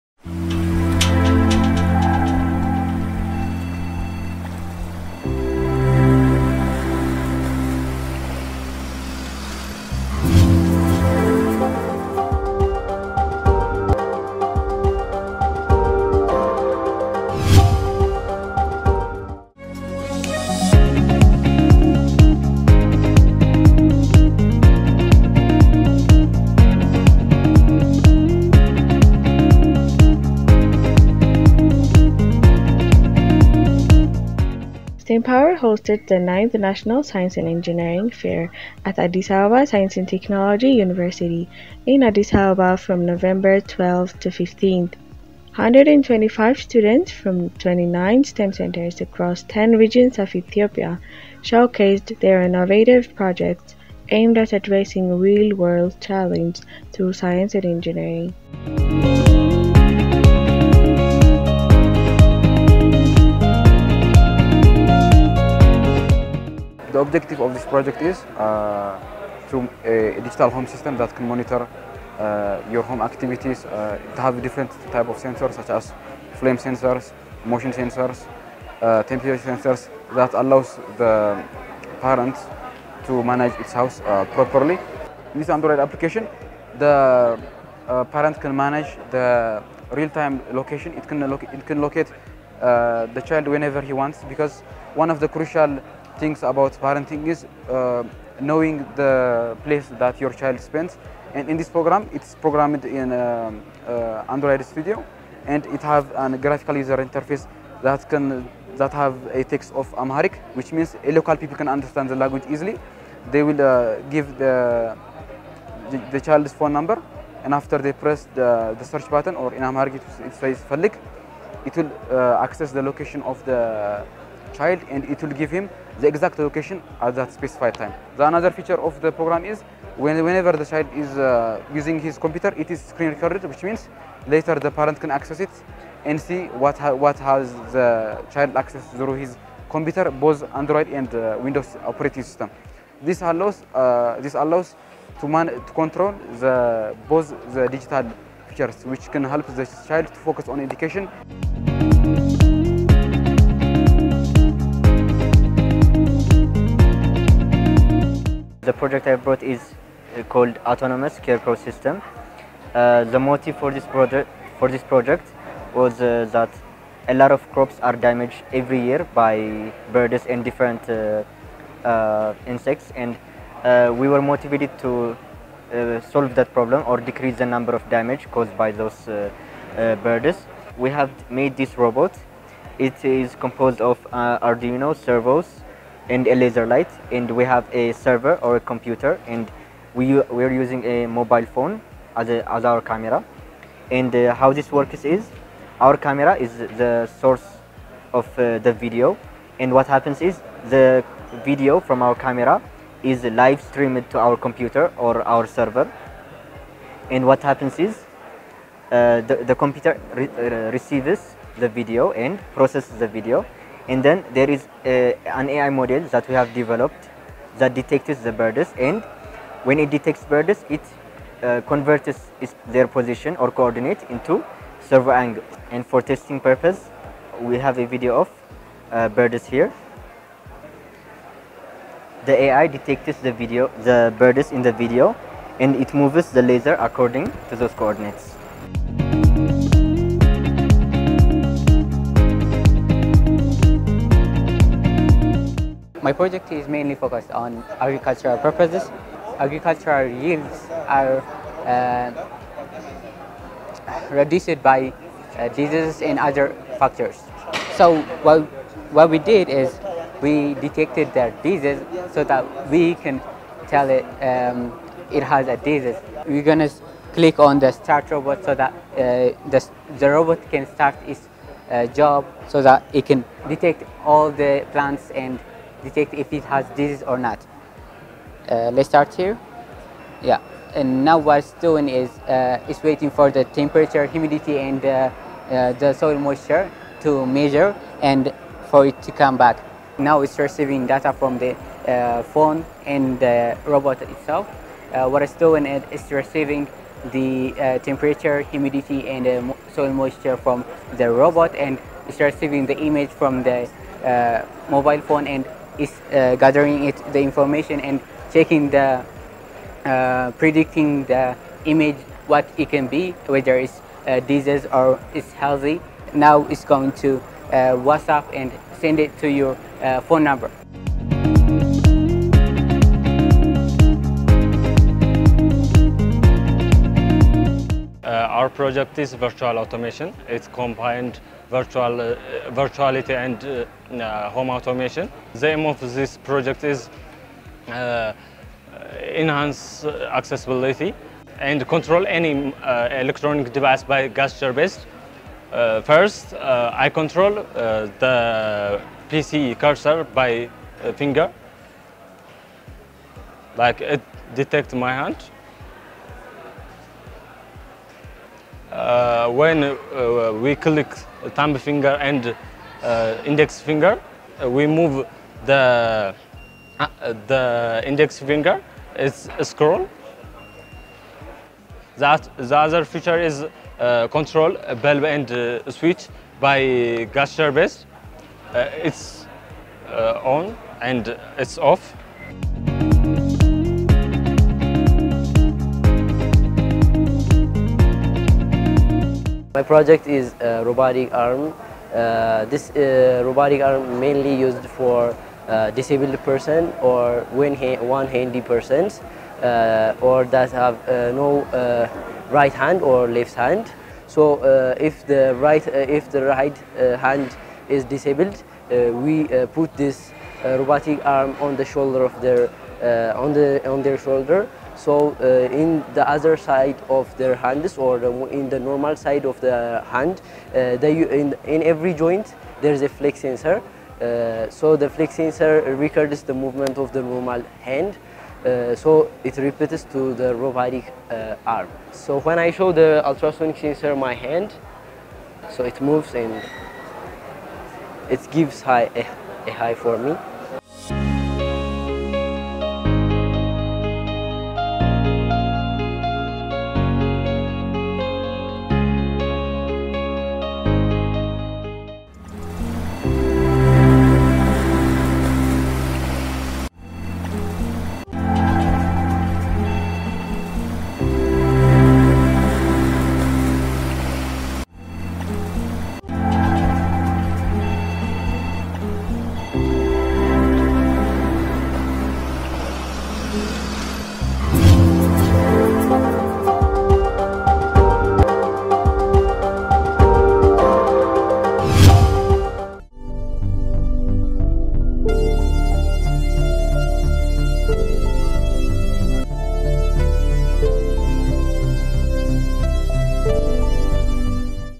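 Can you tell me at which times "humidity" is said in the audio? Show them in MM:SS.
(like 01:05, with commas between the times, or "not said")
04:44, 04:58.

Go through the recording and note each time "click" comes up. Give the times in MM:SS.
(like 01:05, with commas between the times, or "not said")
04:27, 06:00.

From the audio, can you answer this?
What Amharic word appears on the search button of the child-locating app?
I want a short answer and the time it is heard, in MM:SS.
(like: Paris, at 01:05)
Falik, at 02:00.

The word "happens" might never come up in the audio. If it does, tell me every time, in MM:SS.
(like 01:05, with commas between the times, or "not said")
03:19, 03:27.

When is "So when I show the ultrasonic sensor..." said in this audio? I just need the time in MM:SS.
07:11.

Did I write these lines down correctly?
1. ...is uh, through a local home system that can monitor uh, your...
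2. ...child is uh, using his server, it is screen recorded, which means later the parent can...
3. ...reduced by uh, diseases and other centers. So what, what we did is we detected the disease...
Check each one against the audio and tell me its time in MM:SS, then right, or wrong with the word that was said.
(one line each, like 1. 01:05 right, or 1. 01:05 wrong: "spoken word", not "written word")
1. 01:08 wrong: "digital", not "local"
2. 02:10 wrong: "computer", not "server"
3. 04:14 wrong: "factors", not "centers".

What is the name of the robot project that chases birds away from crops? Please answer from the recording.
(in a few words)
Autonomous Care Pro System.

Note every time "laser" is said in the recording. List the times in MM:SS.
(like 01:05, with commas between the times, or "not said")
03:06, 03:56.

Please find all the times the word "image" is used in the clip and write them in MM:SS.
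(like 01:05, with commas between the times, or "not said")
05:02, 05:11.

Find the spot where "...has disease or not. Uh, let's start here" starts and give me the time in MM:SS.
04:36.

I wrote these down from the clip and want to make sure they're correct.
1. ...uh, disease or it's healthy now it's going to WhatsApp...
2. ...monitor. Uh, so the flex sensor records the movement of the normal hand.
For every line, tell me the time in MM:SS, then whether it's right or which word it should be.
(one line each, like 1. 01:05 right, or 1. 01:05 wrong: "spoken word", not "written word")
1. 05:14 right
2. 07:03 wrong: "sensor", not "monitor".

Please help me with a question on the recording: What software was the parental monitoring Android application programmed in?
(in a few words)
Android Studio.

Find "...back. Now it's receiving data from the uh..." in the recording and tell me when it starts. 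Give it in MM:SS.
04:49.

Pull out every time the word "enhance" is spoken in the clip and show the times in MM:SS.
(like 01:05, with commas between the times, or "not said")
05:39.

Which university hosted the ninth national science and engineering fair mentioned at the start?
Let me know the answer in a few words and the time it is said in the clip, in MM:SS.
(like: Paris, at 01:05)
Addis Ababa Science and Technology University, at 00:38.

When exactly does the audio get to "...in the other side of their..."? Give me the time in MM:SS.
06:55.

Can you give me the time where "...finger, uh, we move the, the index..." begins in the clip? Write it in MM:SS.
06:03.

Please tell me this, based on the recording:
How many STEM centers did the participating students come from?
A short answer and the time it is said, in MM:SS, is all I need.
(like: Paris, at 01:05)
29, at 00:47.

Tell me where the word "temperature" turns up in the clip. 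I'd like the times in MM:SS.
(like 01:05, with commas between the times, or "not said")
01:19, 04:43, 04:57.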